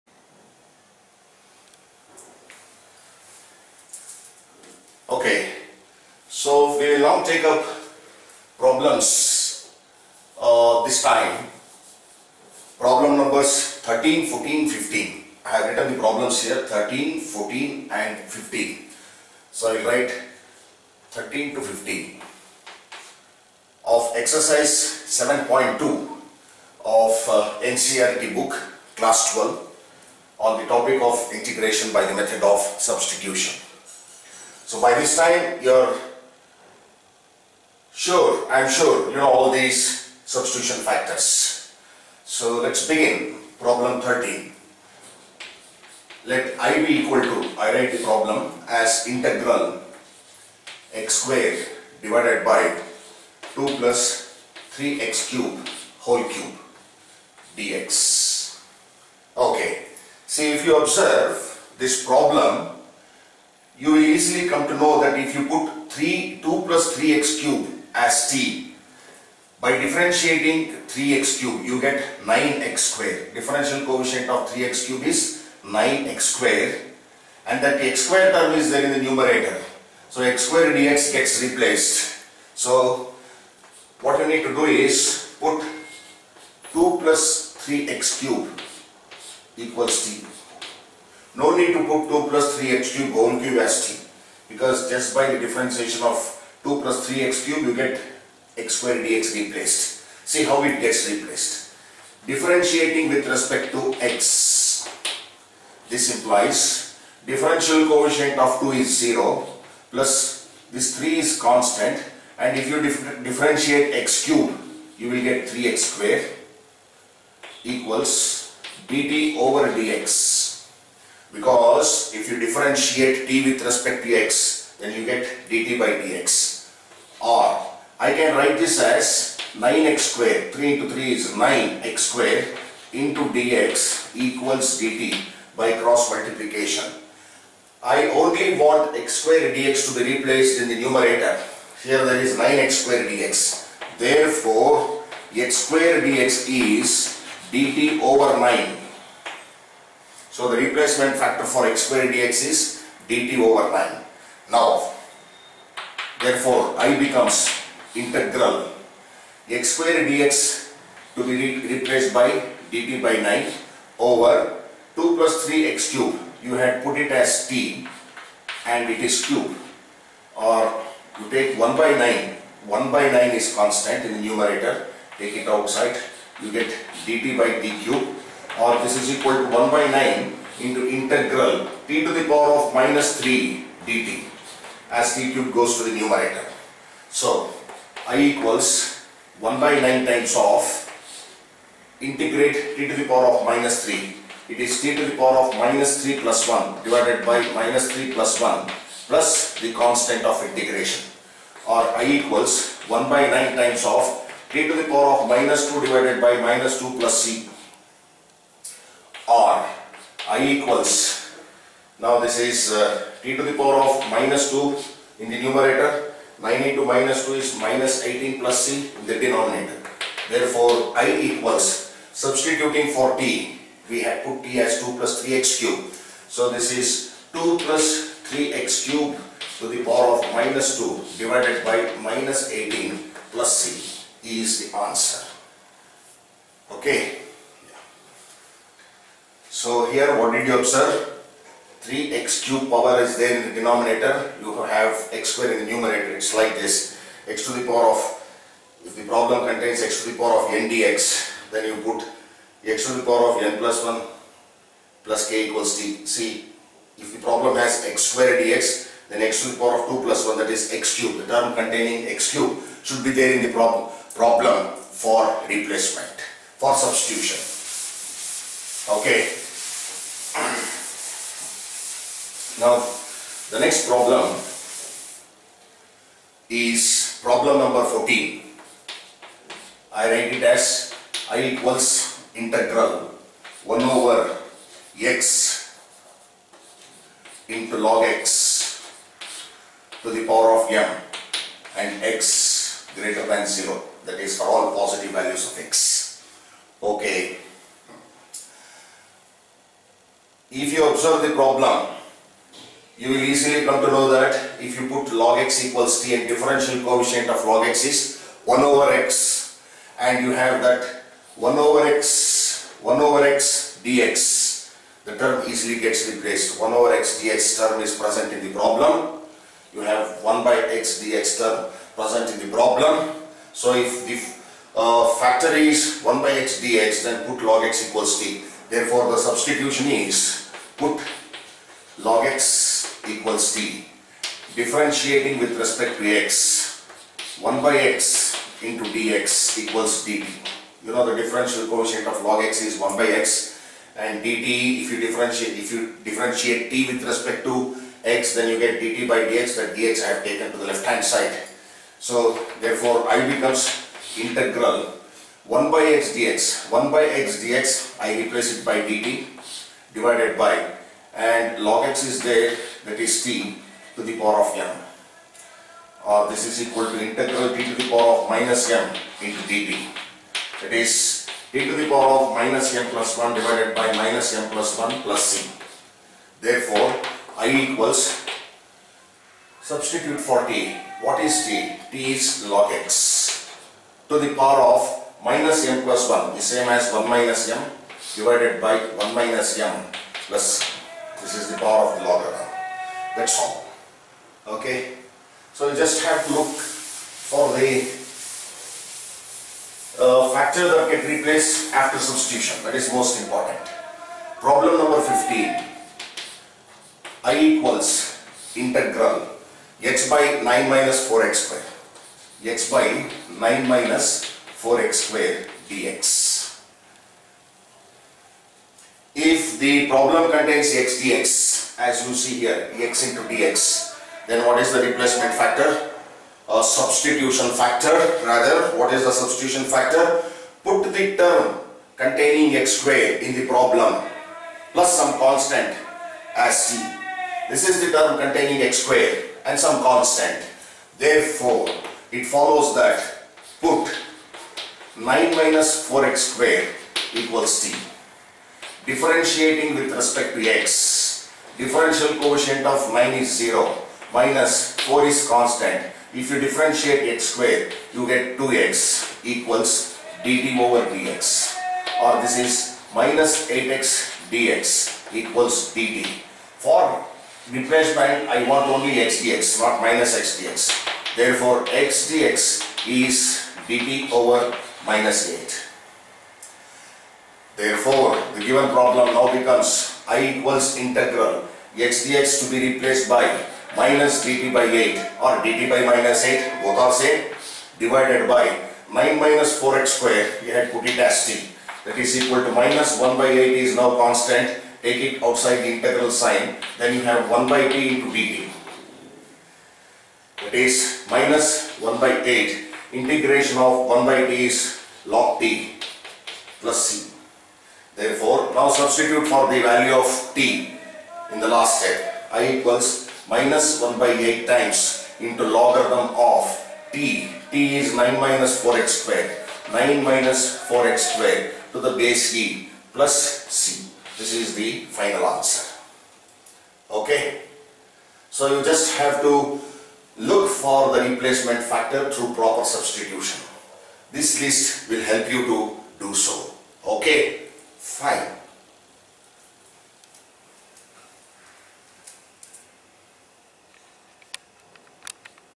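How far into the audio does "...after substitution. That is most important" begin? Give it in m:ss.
6:41.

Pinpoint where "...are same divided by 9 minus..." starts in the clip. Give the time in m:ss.
8:06.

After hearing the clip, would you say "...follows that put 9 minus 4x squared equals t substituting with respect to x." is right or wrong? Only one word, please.
wrong.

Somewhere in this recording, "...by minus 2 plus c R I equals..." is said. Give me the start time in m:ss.
3:26.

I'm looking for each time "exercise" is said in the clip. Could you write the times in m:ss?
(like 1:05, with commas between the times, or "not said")
0:24.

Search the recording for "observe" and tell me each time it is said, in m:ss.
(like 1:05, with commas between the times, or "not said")
1:00, 4:00, 5:00.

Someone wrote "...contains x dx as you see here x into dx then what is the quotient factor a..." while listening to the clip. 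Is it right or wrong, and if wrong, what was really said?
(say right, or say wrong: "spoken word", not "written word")
wrong: "replacement", not "quotient".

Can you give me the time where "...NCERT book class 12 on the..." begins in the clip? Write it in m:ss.
0:27.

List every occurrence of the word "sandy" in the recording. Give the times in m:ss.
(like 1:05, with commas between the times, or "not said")
not said.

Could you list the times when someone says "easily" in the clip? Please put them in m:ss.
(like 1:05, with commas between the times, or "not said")
1:04, 5:03, 5:15.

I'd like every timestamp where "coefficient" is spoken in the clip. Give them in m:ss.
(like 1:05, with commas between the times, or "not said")
1:13, 1:47, 5:06, 5:41.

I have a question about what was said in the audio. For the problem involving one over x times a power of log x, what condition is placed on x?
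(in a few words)
x greater than 0.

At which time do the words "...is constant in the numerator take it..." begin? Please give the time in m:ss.
2:53.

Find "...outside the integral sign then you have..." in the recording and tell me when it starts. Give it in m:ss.
8:15.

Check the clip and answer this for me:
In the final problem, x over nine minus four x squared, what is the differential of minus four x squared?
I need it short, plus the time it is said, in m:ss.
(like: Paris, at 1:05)
-8x dx, at 7:42.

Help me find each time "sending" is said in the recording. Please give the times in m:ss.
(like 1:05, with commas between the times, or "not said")
not said.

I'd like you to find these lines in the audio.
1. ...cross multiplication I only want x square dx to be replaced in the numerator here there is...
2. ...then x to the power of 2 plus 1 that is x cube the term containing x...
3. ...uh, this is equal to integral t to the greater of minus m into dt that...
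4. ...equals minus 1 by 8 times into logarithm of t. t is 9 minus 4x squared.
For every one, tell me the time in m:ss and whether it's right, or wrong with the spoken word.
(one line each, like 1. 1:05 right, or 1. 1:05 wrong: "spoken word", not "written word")
1. 2:15 right
2. 4:19 right
3. 6:06 wrong: "power", not "greater"
4. 8:32 right.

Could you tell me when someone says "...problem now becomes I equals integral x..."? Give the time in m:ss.
7:58.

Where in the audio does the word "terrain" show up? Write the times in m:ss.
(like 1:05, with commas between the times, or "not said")
not said.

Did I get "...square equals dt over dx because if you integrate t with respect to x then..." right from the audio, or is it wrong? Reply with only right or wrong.
wrong.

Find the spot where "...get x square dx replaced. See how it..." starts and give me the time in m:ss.
1:37.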